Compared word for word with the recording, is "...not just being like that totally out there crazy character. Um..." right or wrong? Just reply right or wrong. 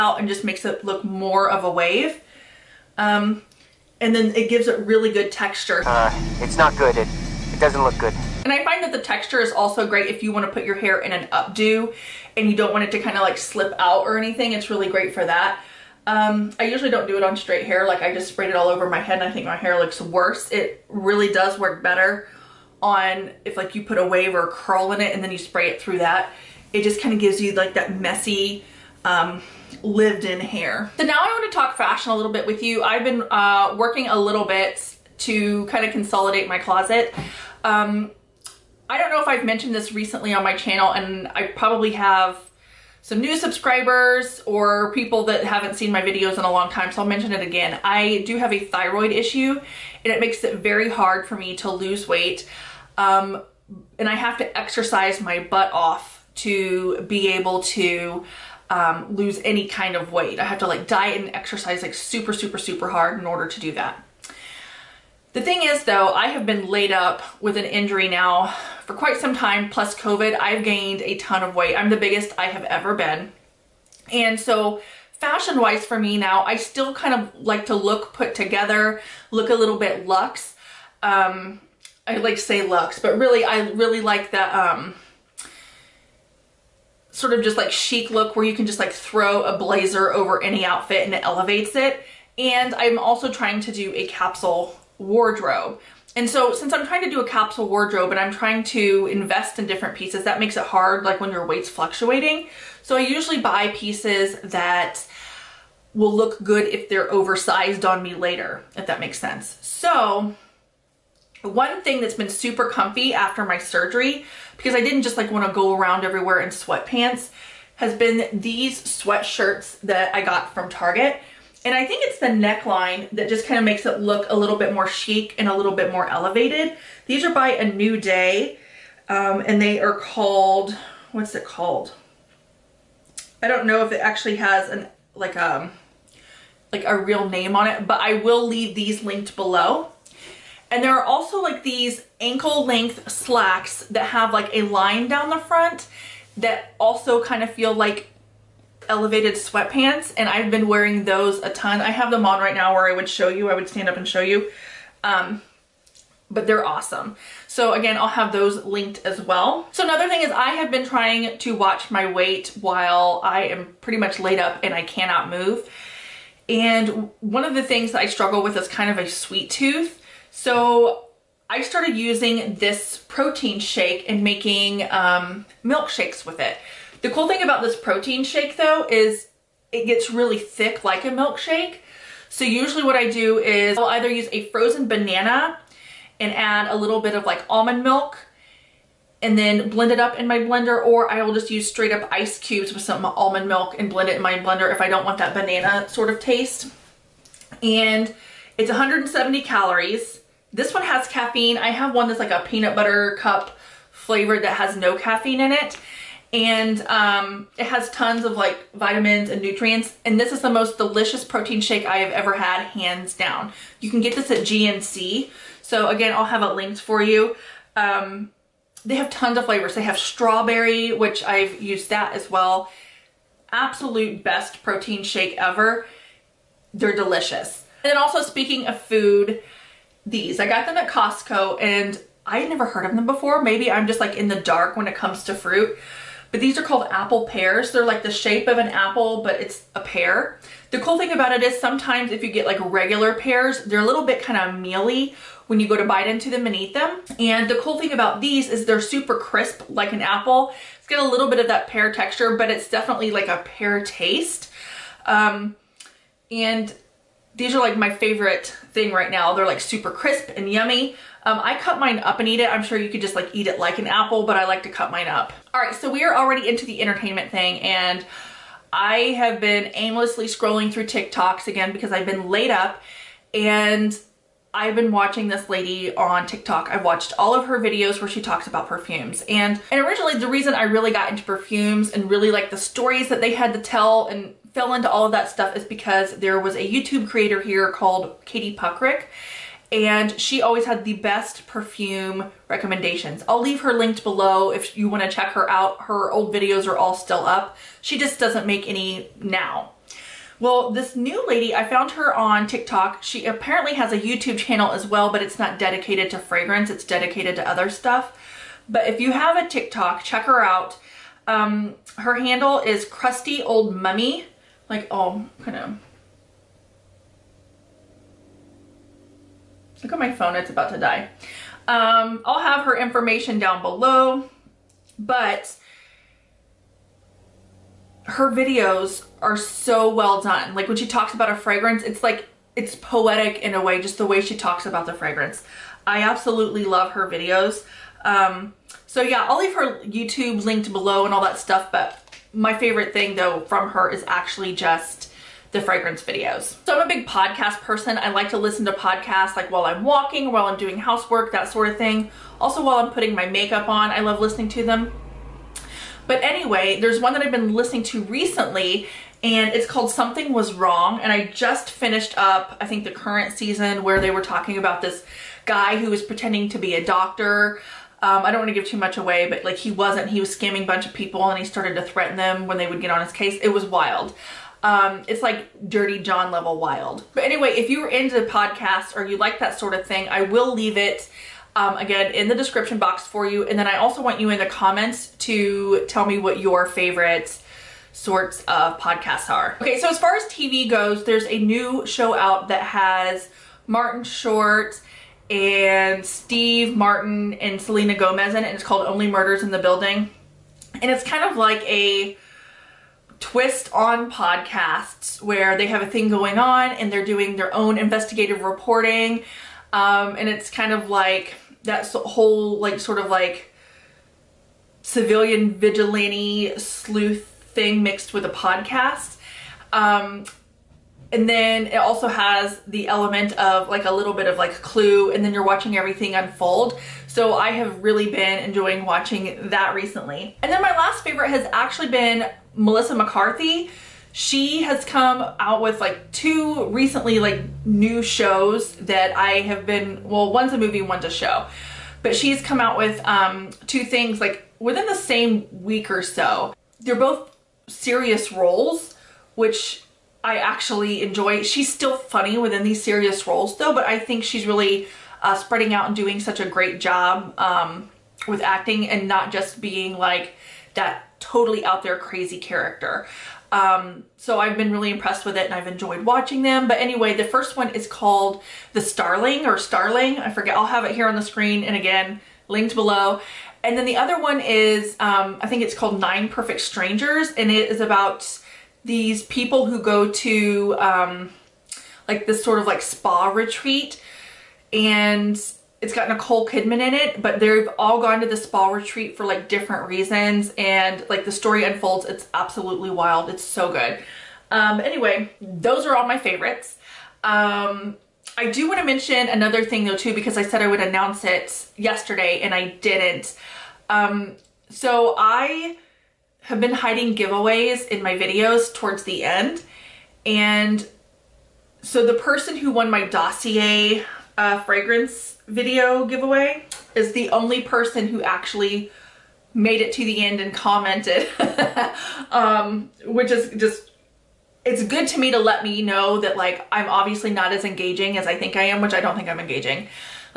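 right.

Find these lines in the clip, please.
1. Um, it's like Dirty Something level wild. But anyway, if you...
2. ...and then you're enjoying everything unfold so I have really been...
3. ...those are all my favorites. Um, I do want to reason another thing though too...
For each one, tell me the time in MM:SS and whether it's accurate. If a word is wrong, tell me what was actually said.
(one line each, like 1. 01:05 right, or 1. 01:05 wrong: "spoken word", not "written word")
1. 06:14 wrong: "John", not "Something"
2. 07:05 wrong: "watching", not "enjoying"
3. 08:15 wrong: "mention", not "reason".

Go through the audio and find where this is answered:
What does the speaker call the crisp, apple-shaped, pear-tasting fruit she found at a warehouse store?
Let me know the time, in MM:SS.
03:56.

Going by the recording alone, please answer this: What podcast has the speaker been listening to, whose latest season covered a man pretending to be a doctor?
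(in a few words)
Something Was Wrong.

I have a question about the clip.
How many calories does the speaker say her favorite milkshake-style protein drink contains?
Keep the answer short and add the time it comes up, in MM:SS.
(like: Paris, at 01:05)
170, at 03:18.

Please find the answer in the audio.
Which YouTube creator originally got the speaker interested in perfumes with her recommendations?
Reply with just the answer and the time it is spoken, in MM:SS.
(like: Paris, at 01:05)
Katie Puckrik, at 04:48.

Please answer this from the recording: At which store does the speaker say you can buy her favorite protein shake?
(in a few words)
GNC.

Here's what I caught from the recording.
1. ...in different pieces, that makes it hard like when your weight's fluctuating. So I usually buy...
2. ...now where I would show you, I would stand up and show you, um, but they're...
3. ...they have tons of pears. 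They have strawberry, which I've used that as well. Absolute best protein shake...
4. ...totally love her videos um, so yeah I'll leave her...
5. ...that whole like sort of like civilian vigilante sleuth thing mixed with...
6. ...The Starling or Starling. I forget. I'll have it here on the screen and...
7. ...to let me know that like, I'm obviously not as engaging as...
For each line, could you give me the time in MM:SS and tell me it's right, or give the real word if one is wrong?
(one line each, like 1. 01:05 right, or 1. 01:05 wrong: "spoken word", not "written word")
1. 01:39 right
2. 02:32 right
3. 03:38 wrong: "flavors", not "pears"
4. 05:36 wrong: "absolutely", not "totally"
5. 06:51 right
6. 07:48 right
7. 08:45 right.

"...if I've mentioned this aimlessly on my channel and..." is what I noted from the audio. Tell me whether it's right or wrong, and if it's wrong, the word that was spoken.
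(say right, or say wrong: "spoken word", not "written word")
wrong: "recently", not "aimlessly".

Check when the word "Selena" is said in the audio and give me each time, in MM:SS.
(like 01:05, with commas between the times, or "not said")
06:37.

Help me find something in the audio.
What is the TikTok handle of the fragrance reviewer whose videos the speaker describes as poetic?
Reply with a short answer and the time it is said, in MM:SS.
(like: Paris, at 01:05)
Crusty Old Mummy, at 05:12.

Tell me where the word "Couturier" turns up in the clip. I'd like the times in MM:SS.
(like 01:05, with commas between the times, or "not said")
not said.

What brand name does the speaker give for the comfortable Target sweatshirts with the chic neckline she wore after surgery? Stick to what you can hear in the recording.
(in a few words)
A New Day.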